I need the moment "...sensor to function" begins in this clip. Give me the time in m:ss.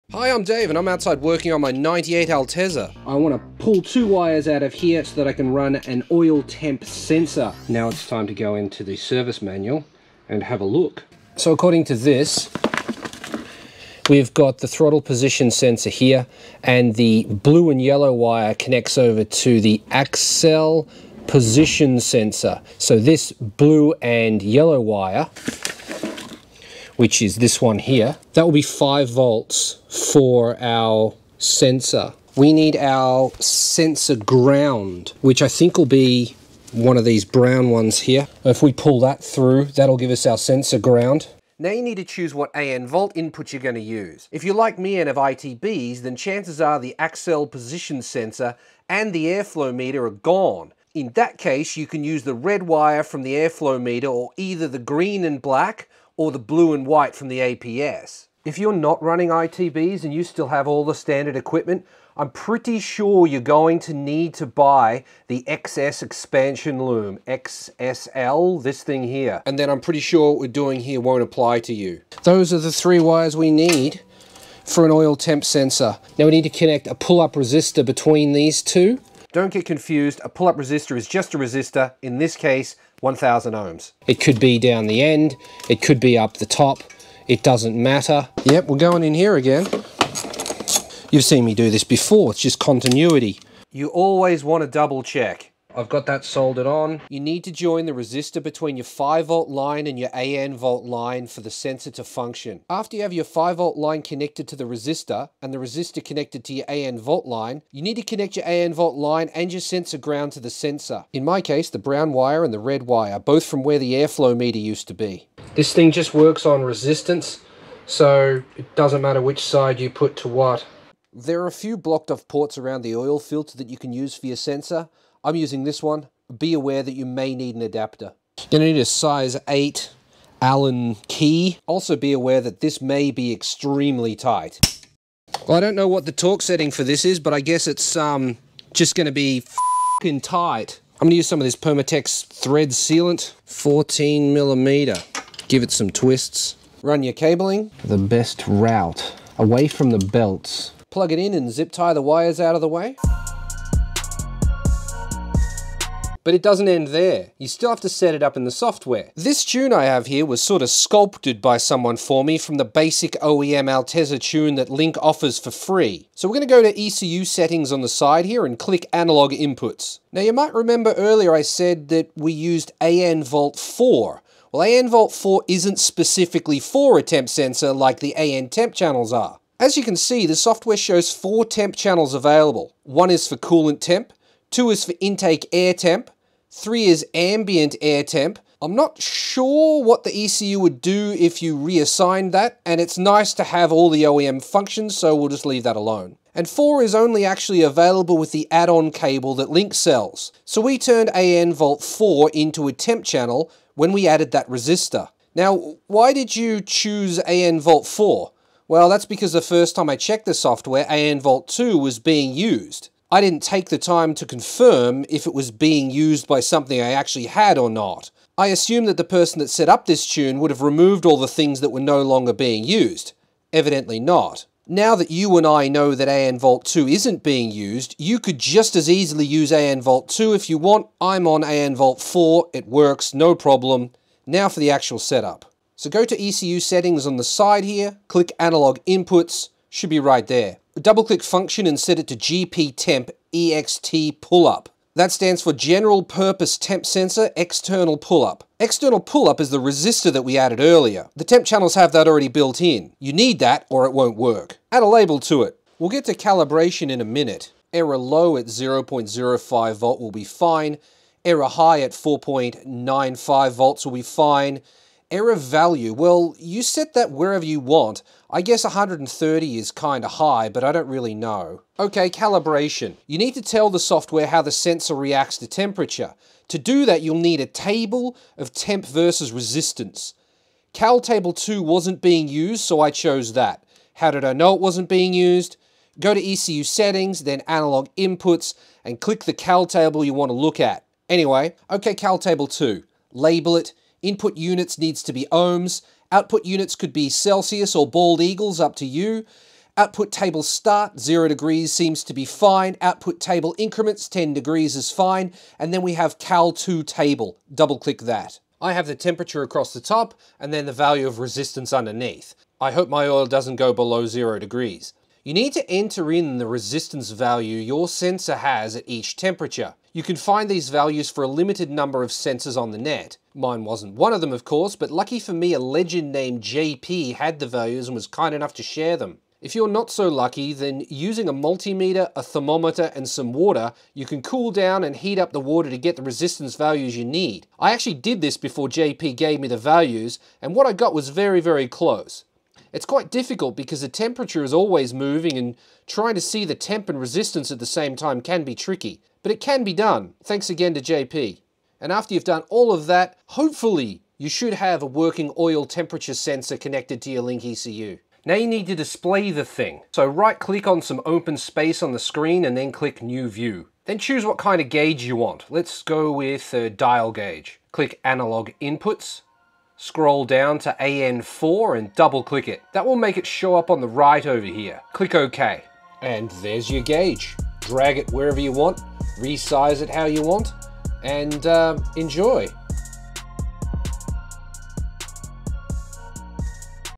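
1:41.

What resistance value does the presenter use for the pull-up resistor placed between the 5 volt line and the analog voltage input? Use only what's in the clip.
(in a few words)
1,000 ohms.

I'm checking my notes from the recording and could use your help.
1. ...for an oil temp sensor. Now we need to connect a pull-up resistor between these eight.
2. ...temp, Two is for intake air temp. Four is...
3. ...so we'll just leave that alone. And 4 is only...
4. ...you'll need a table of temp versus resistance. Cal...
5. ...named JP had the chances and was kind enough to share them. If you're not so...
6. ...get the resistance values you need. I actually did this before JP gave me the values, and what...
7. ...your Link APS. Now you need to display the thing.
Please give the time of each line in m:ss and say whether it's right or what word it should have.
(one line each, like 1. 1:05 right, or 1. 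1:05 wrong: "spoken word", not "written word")
1. 1:14 wrong: "two", not "eight"
2. 3:03 wrong: "Three", not "Four"
3. 3:14 right
4. 4:37 right
5. 5:26 wrong: "values", not "chances"
6. 5:35 right
7. 5:57 wrong: "ECU", not "APS".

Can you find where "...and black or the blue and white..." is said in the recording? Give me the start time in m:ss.
0:55.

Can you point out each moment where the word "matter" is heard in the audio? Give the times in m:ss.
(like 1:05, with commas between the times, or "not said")
1:27, 1:59.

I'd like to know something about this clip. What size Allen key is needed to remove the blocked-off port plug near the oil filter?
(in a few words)
size 8.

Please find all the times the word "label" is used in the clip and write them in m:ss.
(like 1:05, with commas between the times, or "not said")
4:14, 4:53.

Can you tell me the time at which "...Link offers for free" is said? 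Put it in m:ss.
2:44.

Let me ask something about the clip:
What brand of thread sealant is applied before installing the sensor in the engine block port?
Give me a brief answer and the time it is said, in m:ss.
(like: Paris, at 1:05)
Permatex, at 2:21.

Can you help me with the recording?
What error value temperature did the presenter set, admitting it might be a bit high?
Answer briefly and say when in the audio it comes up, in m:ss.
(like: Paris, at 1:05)
130, at 4:28.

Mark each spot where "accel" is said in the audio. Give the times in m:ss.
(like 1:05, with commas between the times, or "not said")
0:19, 0:46.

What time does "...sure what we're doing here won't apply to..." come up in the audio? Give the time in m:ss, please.
1:09.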